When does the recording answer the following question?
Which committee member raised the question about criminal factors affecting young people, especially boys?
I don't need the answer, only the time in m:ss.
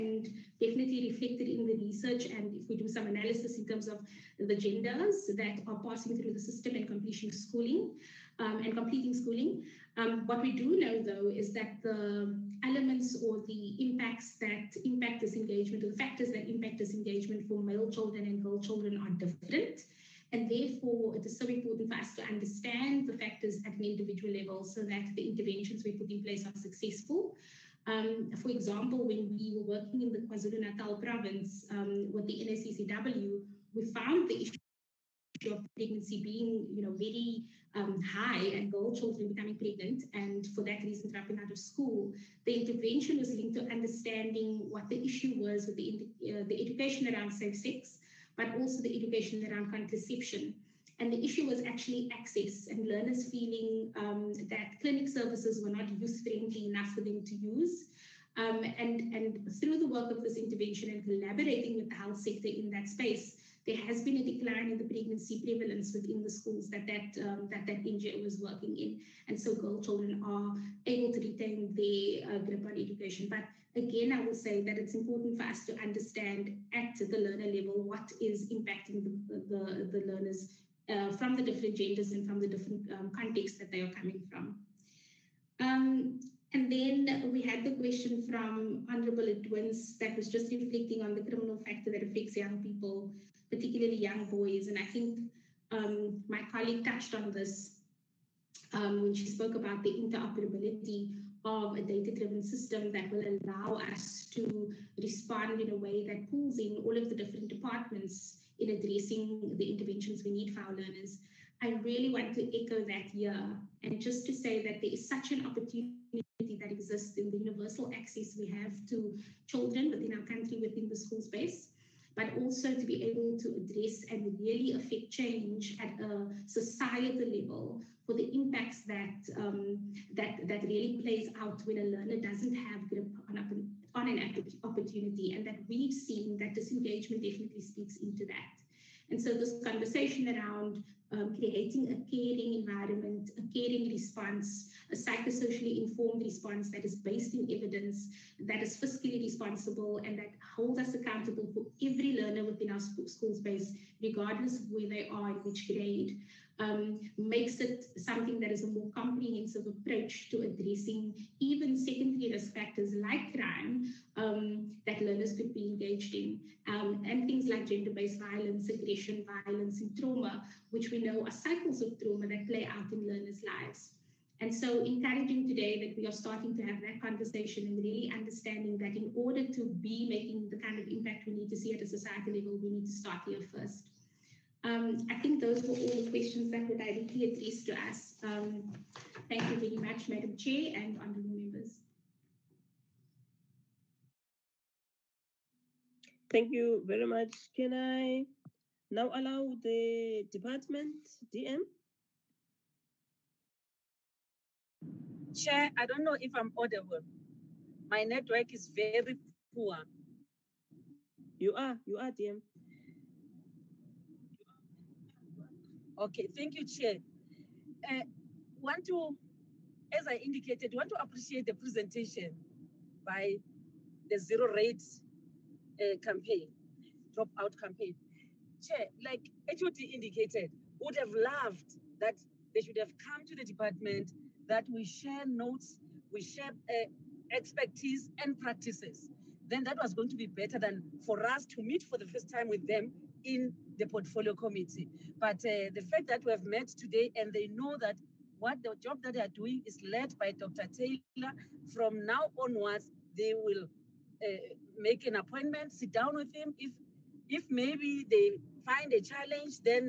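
1:28.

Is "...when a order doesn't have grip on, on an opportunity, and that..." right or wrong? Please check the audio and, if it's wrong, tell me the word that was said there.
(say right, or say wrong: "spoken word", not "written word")
wrong: "learner", not "order".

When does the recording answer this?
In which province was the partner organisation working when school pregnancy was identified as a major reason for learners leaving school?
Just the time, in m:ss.
0:30.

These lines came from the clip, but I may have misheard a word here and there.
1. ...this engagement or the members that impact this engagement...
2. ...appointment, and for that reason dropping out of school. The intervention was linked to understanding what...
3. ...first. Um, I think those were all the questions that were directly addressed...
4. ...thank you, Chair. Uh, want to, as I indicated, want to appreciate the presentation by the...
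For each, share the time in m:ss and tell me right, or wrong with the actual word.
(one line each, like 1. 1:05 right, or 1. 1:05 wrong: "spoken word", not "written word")
1. 0:15 wrong: "factors", not "members"
2. 0:39 wrong: "pregnant", not "appointment"
3. 3:03 right
4. 3:36 right.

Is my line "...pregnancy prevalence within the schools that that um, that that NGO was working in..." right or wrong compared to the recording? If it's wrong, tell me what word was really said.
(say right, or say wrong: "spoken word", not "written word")
right.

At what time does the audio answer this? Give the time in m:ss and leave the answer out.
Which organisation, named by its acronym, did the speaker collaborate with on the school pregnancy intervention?
0:32.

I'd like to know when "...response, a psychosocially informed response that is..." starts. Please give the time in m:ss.
2:23.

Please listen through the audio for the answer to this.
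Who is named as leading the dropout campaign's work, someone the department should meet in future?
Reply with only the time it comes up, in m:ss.
4:10.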